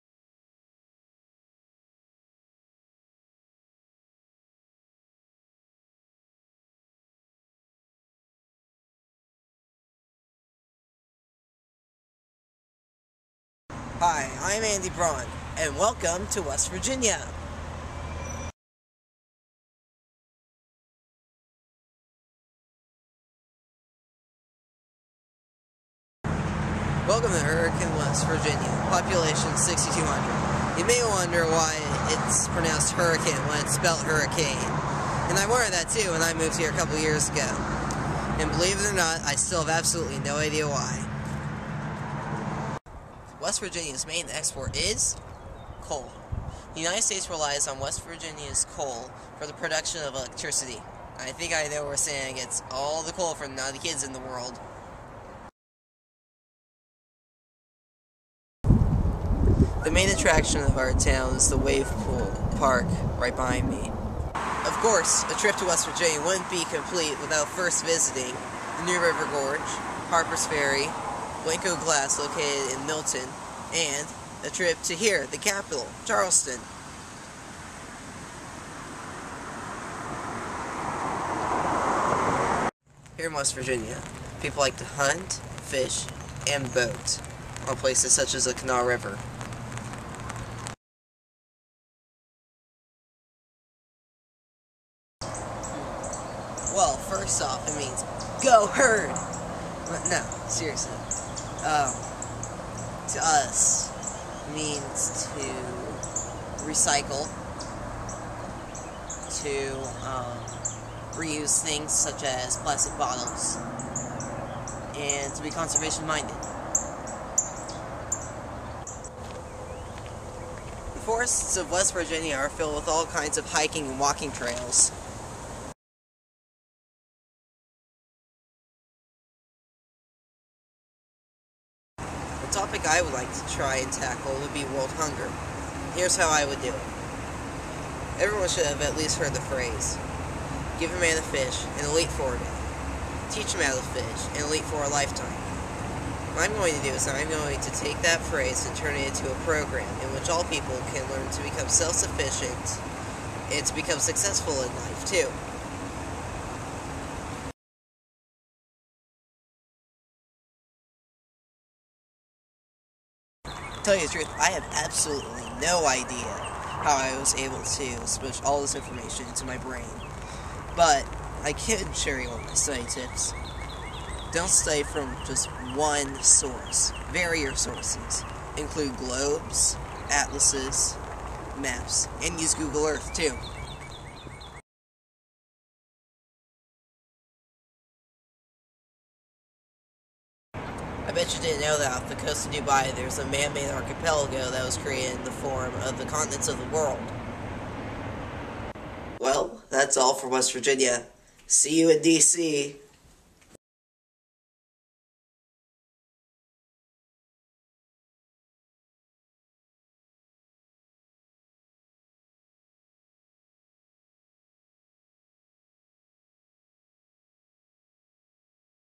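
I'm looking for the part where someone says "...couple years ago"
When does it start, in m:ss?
0:36.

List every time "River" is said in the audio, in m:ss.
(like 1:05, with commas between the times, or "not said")
1:09, 1:28.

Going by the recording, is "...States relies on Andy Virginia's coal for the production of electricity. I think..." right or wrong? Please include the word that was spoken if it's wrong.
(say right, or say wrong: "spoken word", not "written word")
wrong: "West", not "Andy".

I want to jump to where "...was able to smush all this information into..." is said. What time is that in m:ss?
2:47.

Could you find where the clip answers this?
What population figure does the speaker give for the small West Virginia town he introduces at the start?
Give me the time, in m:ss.
0:29.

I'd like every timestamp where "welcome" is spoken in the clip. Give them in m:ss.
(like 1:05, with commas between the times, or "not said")
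0:15, 0:27.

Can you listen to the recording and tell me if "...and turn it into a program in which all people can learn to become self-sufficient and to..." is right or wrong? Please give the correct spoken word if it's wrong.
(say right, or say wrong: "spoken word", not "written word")
right.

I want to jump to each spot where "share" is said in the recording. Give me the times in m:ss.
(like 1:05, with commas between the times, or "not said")
2:51.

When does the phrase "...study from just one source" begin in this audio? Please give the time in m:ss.
2:54.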